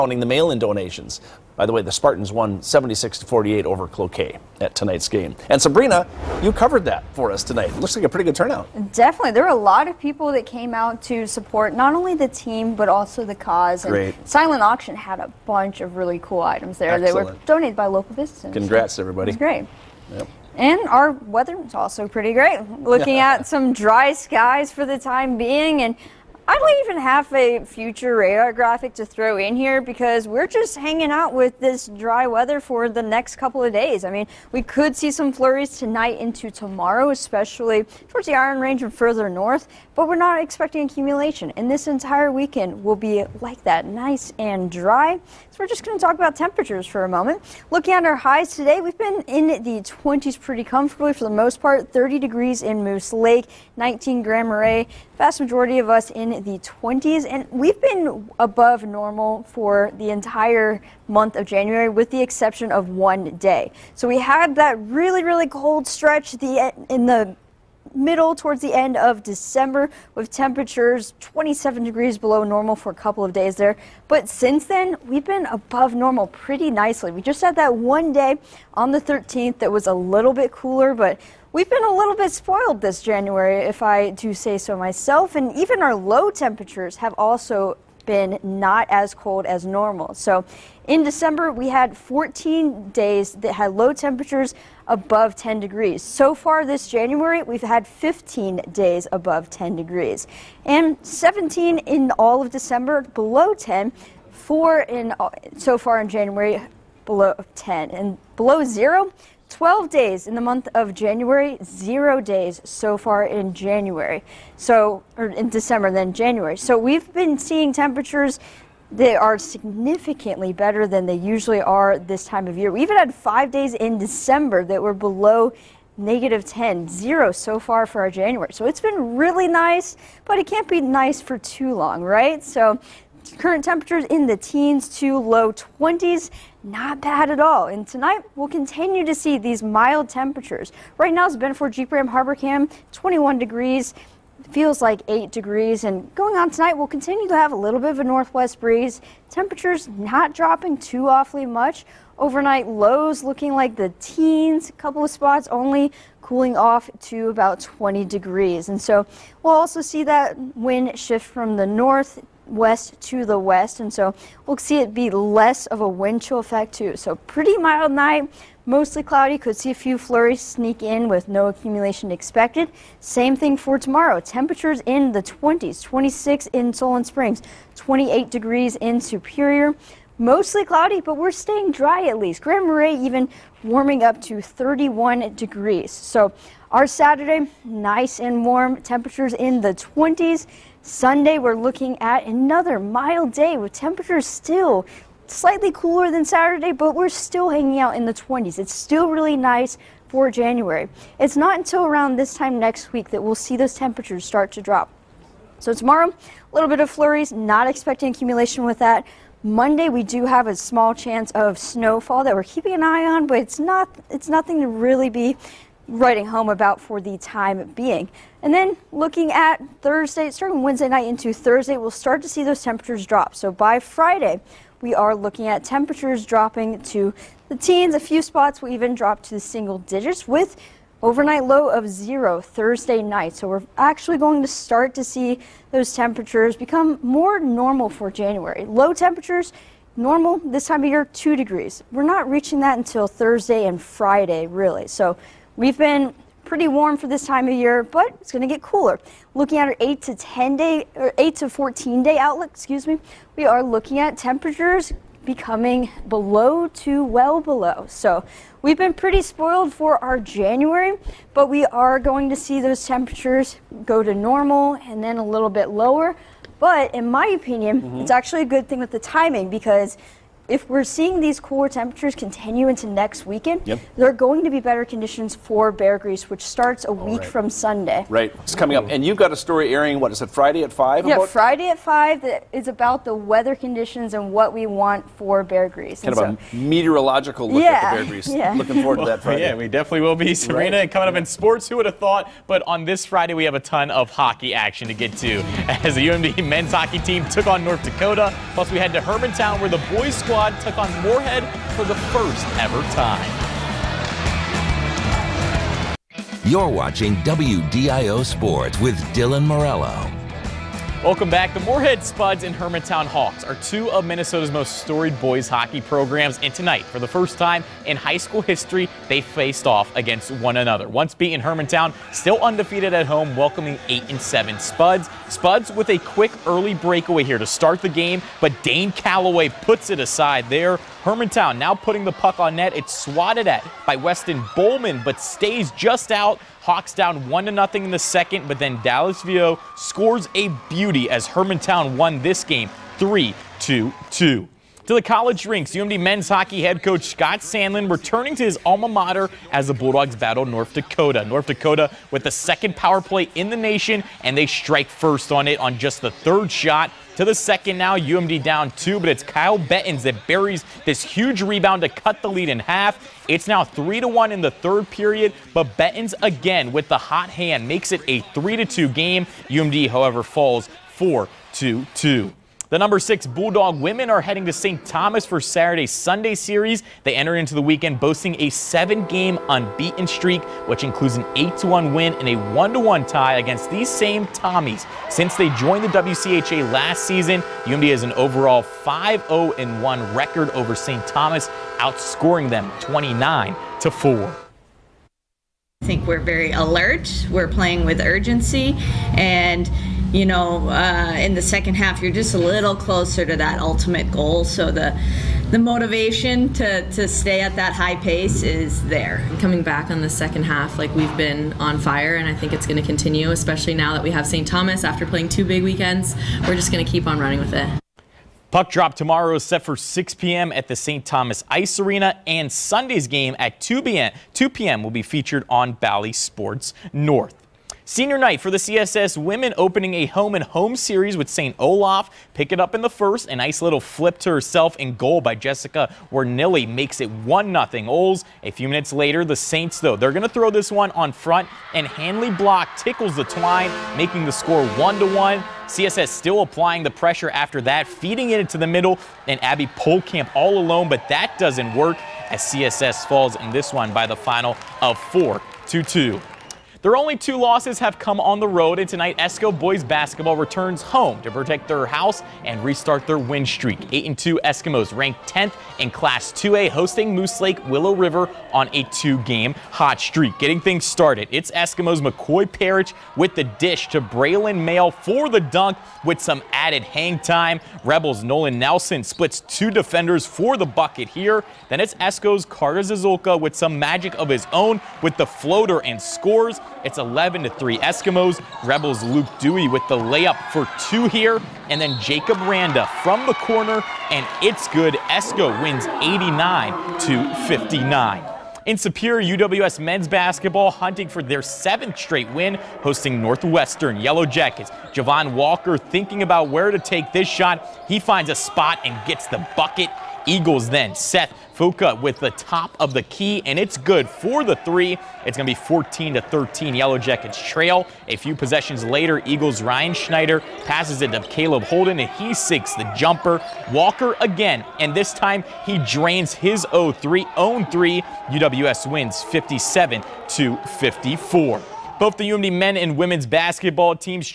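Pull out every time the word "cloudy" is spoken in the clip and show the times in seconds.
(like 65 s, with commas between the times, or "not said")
169 s, 180 s.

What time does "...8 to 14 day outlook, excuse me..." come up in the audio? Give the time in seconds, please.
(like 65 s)
251 s.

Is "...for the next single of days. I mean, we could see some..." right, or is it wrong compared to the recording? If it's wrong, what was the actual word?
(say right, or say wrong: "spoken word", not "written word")
wrong: "couple", not "single".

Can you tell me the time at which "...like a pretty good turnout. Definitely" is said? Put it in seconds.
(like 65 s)
7 s.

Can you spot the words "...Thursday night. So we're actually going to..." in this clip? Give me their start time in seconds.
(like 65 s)
232 s.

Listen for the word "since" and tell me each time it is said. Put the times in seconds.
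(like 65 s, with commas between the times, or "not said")
74 s, 385 s.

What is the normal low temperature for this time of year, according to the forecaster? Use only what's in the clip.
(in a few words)
2 degrees.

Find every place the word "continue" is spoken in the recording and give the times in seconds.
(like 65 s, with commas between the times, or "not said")
138 s, 146 s, 272 s, 412 s.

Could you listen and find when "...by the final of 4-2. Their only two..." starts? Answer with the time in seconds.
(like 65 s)
453 s.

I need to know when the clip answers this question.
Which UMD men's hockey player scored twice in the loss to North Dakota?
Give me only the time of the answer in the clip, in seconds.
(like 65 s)
359 s.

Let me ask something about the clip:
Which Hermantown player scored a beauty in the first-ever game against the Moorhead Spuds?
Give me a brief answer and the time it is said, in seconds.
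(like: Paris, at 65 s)
Dallas Vio, at 338 s.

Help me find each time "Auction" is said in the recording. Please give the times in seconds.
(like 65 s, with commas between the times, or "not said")
14 s.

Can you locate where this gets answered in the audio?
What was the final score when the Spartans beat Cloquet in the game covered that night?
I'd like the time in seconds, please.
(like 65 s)
2 s.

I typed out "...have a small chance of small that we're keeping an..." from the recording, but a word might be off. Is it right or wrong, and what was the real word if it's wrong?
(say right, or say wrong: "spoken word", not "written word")
wrong: "snowfall", not "small".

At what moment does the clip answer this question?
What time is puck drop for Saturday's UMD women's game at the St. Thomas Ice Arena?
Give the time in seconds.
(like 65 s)
419 s.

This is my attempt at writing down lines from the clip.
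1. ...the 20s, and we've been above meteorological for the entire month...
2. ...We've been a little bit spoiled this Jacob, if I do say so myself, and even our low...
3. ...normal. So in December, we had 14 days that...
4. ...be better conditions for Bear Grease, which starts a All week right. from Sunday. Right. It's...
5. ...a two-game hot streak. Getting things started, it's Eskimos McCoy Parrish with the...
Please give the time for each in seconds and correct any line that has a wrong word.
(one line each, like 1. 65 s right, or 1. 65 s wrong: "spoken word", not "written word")
1. 56 s wrong: "normal", not "meteorological"
2. 81 s wrong: "January", not "Jacob"
3. 89 s right
4. 274 s right
5. 468 s right.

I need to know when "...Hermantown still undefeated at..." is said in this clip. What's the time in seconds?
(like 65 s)
321 s.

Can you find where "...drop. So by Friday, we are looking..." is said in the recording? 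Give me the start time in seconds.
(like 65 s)
223 s.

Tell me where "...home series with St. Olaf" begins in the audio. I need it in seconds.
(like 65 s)
430 s.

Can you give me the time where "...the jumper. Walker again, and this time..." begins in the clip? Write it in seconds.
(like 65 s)
522 s.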